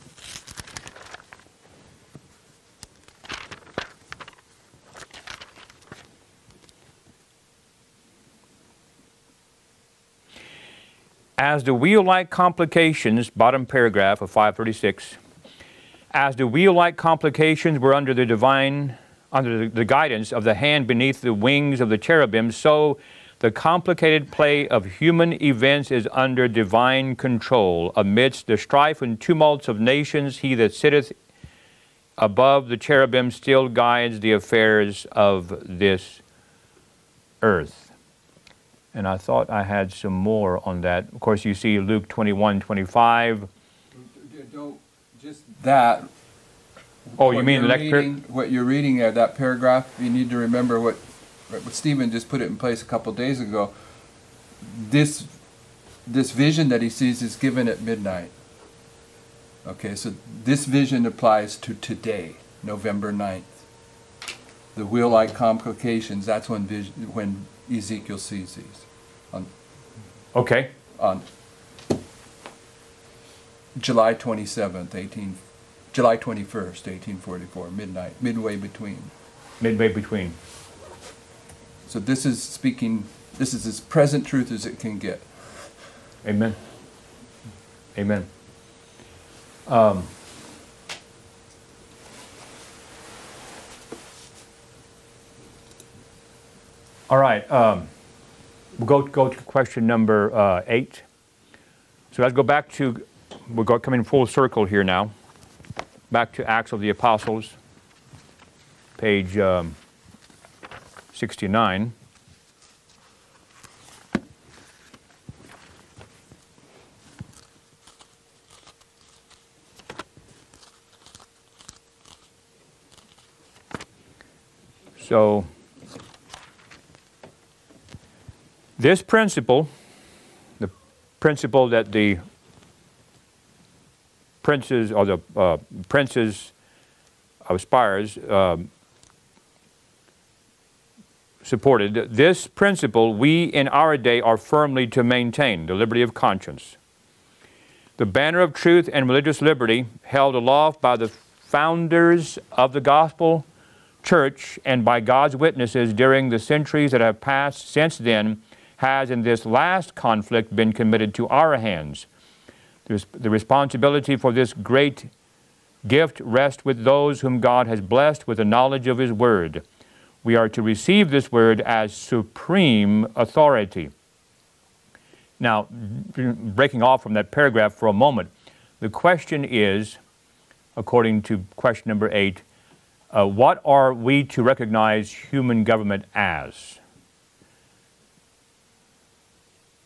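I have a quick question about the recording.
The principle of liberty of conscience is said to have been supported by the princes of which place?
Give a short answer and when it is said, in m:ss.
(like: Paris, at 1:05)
Spires, at 2:17.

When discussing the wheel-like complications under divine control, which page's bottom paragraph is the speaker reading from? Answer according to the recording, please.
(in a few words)
536.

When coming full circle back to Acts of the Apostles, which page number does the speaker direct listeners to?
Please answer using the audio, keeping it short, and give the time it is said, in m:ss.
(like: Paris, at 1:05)
69, at 1:51.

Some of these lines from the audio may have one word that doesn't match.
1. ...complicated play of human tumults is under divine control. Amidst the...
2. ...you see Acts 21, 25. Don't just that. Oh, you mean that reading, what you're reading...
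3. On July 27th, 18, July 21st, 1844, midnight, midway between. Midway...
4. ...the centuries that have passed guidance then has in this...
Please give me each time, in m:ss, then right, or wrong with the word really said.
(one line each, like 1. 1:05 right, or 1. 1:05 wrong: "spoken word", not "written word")
1. 0:23 wrong: "events", not "tumults"
2. 0:41 wrong: "Luke", not "Acts"
3. 1:10 right
4. 2:36 wrong: "since", not "guidance".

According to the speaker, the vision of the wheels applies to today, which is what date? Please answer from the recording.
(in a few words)
November 9th.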